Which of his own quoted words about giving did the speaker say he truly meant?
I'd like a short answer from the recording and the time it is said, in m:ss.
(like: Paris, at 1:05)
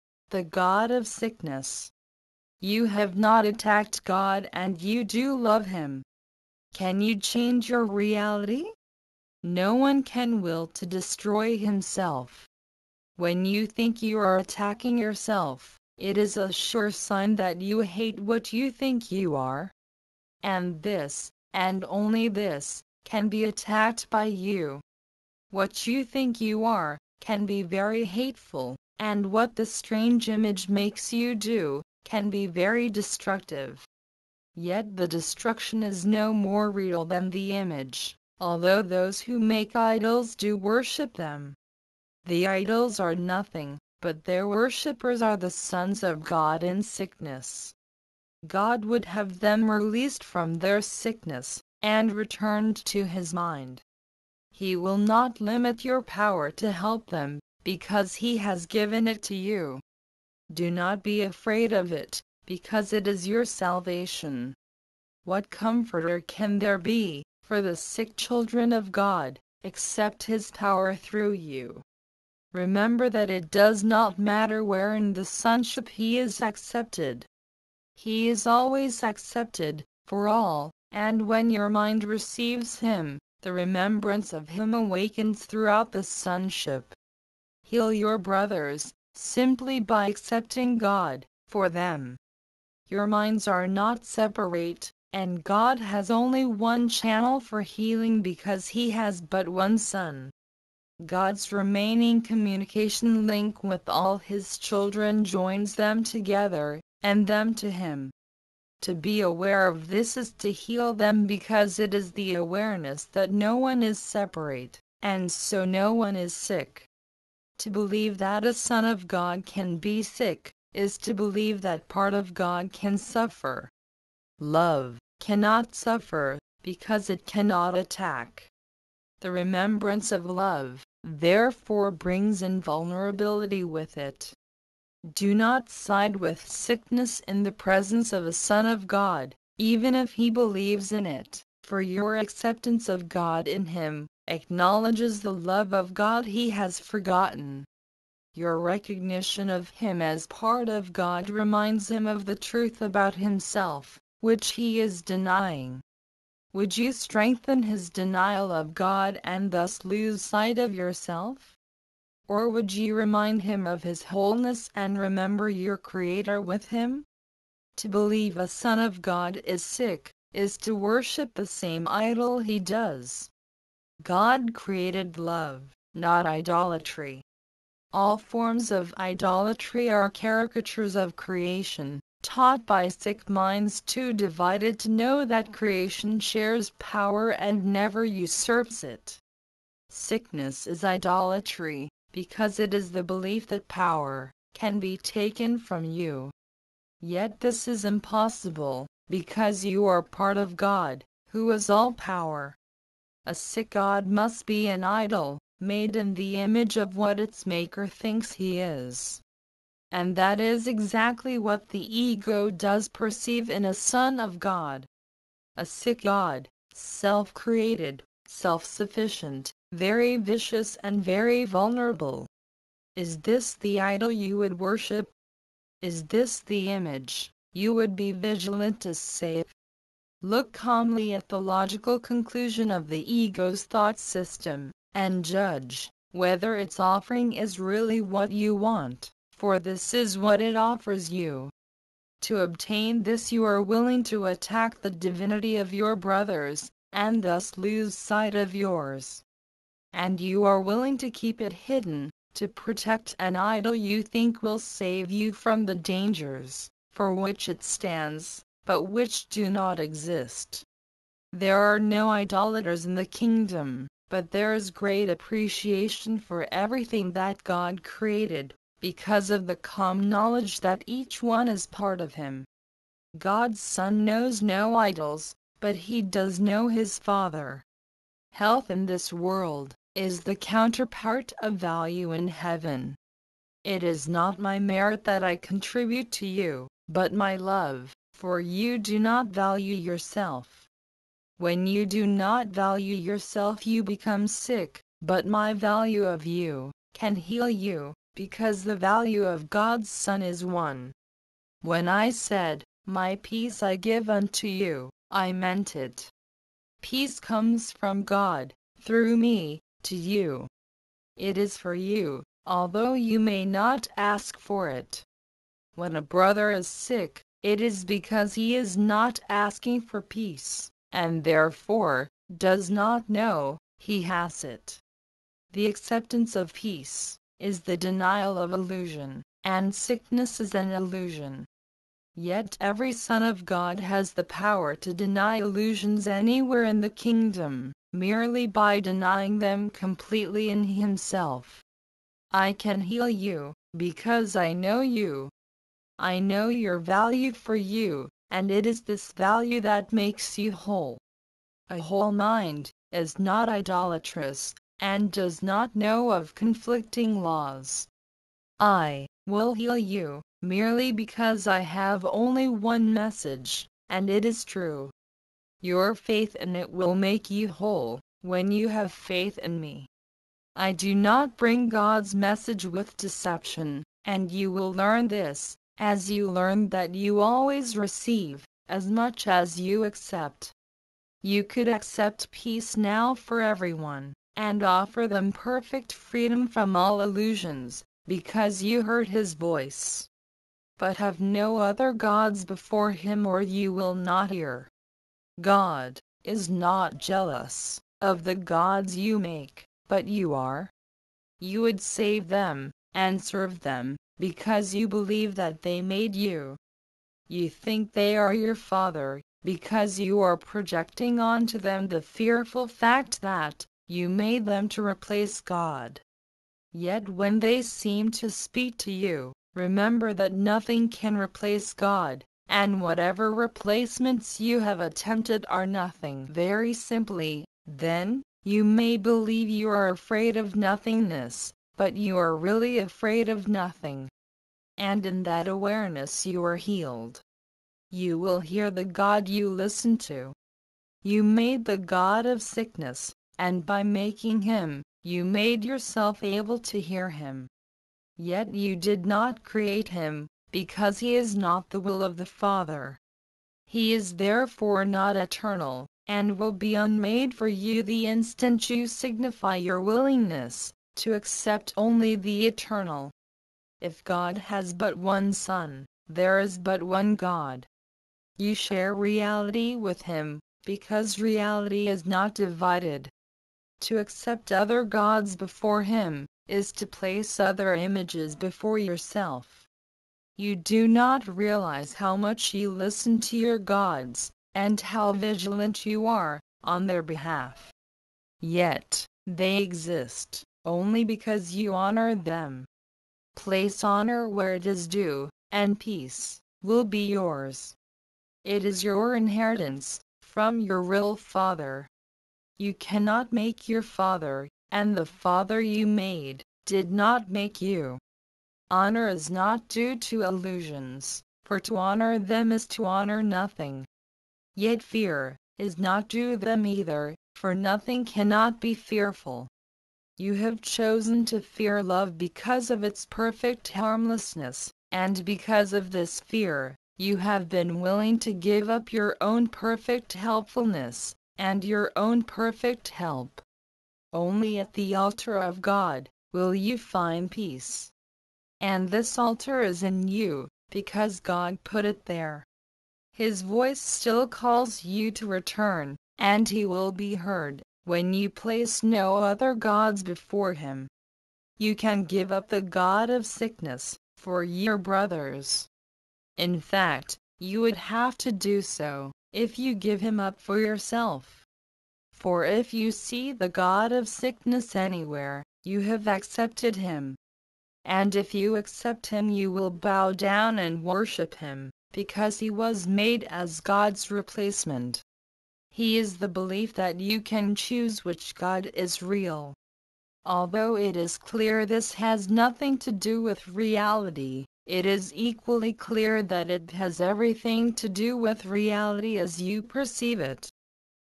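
My peace I give unto you, at 5:02.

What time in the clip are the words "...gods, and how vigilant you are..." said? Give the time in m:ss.
8:03.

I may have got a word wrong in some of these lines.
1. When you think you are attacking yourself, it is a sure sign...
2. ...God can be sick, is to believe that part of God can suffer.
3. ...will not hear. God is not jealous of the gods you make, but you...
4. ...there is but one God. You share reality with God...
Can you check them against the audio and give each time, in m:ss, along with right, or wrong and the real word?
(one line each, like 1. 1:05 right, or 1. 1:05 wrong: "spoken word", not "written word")
1. 0:13 right
2. 1:59 right
3. 6:33 right
4. 7:46 wrong: "Him", not "God".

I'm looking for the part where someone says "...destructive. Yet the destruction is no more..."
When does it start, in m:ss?
0:32.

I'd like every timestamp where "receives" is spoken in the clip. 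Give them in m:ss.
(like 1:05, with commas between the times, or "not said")
1:22, 6:17.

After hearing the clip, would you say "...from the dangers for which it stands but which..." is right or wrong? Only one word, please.
right.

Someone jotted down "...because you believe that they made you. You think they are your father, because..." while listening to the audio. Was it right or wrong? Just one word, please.
right.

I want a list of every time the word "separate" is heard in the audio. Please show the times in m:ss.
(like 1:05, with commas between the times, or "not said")
1:34, 1:53.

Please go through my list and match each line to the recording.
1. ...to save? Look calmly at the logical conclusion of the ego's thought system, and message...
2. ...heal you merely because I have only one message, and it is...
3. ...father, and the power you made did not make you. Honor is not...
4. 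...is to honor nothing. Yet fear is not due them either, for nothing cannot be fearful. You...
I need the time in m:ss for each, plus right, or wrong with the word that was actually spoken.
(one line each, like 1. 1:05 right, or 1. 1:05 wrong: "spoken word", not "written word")
1. 3:48 wrong: "judge", not "message"
2. 5:59 right
3. 8:23 wrong: "father", not "power"
4. 8:32 right.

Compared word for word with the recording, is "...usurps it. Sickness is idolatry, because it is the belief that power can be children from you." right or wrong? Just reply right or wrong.
wrong.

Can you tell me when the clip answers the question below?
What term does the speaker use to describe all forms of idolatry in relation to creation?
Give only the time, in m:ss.
3:00.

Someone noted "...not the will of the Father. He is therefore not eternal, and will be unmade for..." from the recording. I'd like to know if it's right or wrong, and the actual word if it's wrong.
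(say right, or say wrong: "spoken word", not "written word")
right.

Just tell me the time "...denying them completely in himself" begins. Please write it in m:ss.
5:38.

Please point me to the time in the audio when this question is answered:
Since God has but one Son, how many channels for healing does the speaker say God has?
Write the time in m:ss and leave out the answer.
1:36.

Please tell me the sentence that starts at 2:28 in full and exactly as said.
Your recognition of him as part of God reminds him of the truth about himself, which he is denying.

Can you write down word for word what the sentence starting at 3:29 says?
And that is exactly what the ego does perceive in a son of God.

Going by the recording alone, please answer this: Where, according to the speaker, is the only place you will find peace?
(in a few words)
the altar of God.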